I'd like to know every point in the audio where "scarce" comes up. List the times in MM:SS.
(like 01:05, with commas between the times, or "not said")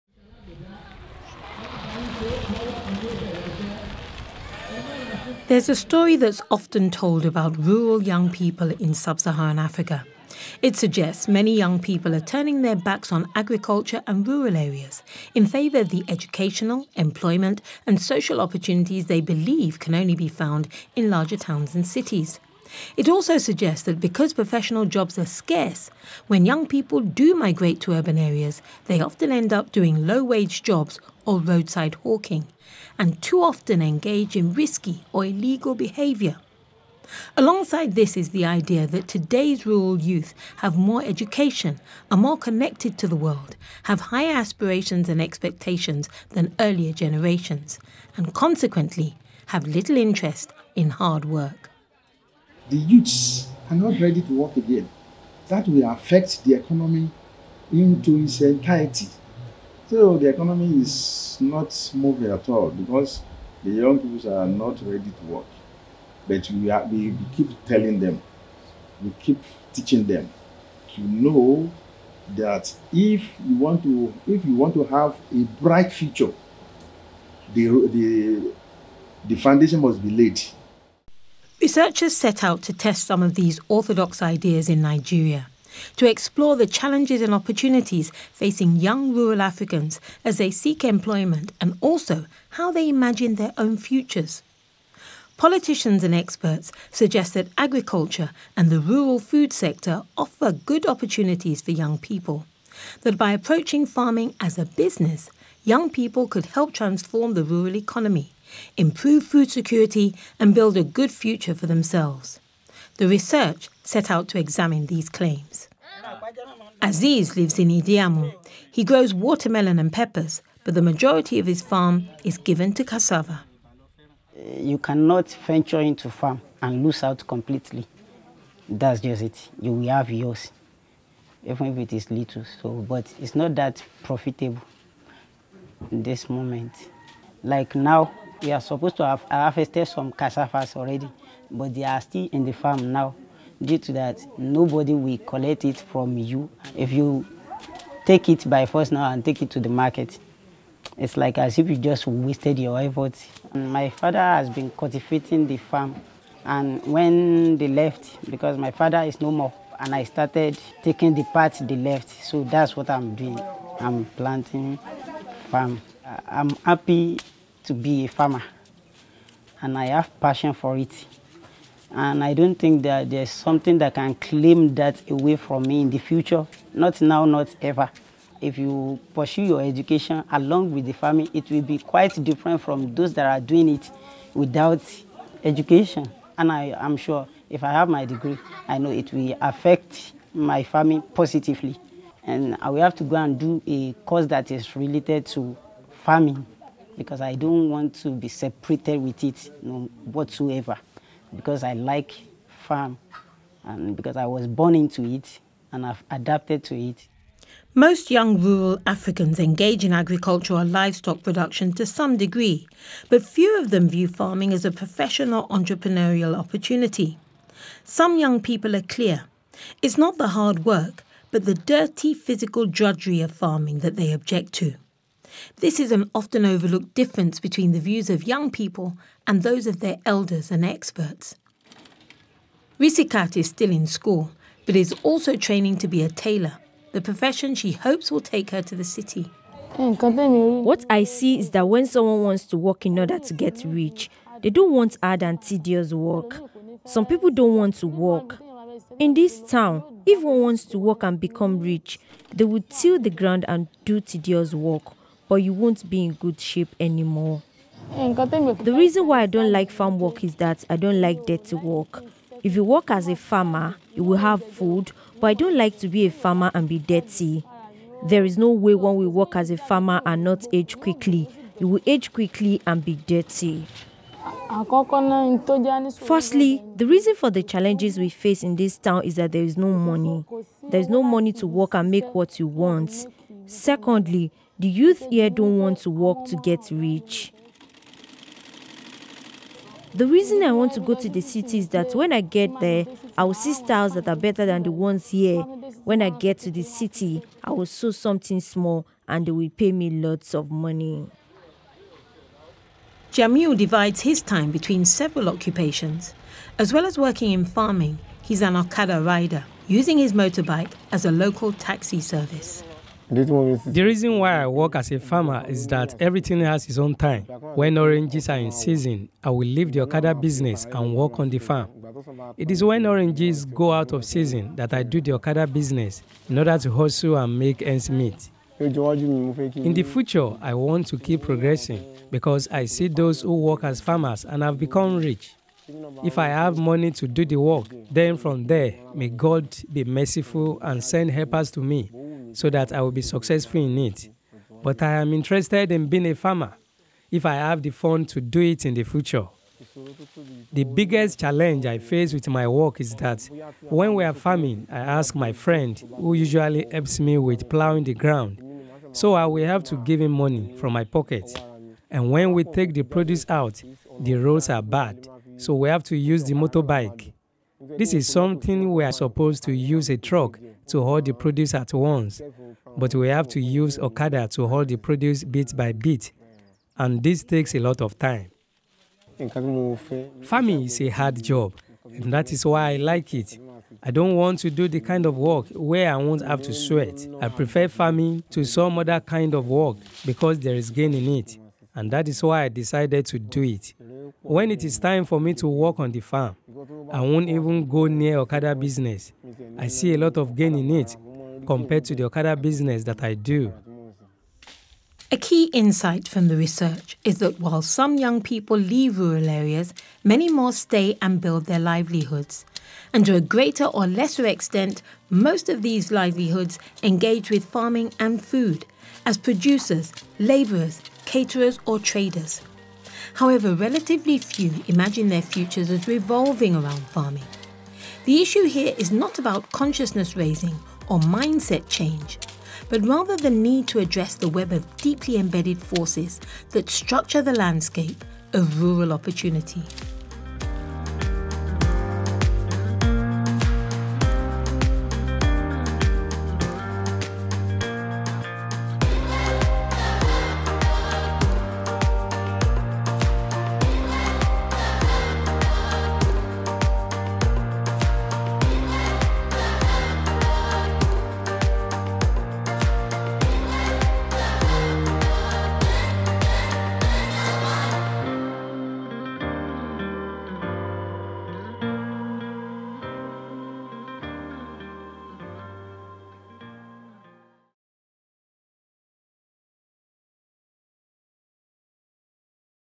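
00:25.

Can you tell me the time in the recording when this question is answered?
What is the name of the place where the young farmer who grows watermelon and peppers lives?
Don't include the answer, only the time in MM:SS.
01:57.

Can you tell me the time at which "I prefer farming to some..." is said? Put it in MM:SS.
06:27.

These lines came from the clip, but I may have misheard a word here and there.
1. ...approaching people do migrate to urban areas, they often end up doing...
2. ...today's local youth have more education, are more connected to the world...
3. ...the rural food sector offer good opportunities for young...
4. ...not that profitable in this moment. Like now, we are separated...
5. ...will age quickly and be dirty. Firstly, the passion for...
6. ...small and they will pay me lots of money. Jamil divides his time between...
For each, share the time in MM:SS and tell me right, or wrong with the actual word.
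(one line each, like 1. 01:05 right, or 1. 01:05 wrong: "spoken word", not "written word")
1. 00:26 wrong: "young", not "approaching"
2. 00:39 wrong: "rural", not "local"
3. 01:38 right
4. 02:13 wrong: "supposed", not "separated"
5. 04:31 wrong: "reason", not "passion"
6. 04:58 right.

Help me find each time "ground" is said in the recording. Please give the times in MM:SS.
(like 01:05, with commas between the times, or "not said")
04:13, 05:57.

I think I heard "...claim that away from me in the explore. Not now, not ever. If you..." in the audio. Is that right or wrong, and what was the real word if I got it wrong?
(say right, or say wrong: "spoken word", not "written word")
wrong: "future", not "explore".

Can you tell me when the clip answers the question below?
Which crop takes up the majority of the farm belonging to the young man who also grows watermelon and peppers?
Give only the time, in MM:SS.
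02:02.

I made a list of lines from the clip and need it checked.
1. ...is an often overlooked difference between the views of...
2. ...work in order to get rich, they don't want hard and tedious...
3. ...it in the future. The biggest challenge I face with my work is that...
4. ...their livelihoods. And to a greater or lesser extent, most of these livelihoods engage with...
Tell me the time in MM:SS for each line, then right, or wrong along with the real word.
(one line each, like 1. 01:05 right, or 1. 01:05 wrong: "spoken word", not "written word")
1. 03:45 right
2. 04:02 right
3. 05:48 right
4. 06:51 right.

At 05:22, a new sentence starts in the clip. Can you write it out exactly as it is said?
It is when oranges go out of season that I do the Okada business in order to hustle and make ends meet.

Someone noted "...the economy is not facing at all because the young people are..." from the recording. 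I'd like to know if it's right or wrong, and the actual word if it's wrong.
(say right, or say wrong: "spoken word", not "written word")
wrong: "moving", not "facing".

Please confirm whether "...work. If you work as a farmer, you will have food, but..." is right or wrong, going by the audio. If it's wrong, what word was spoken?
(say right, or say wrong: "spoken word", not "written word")
right.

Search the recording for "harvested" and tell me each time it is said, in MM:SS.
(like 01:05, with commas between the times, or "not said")
02:19.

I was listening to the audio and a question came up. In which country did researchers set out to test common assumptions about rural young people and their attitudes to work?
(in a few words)
Nigeria.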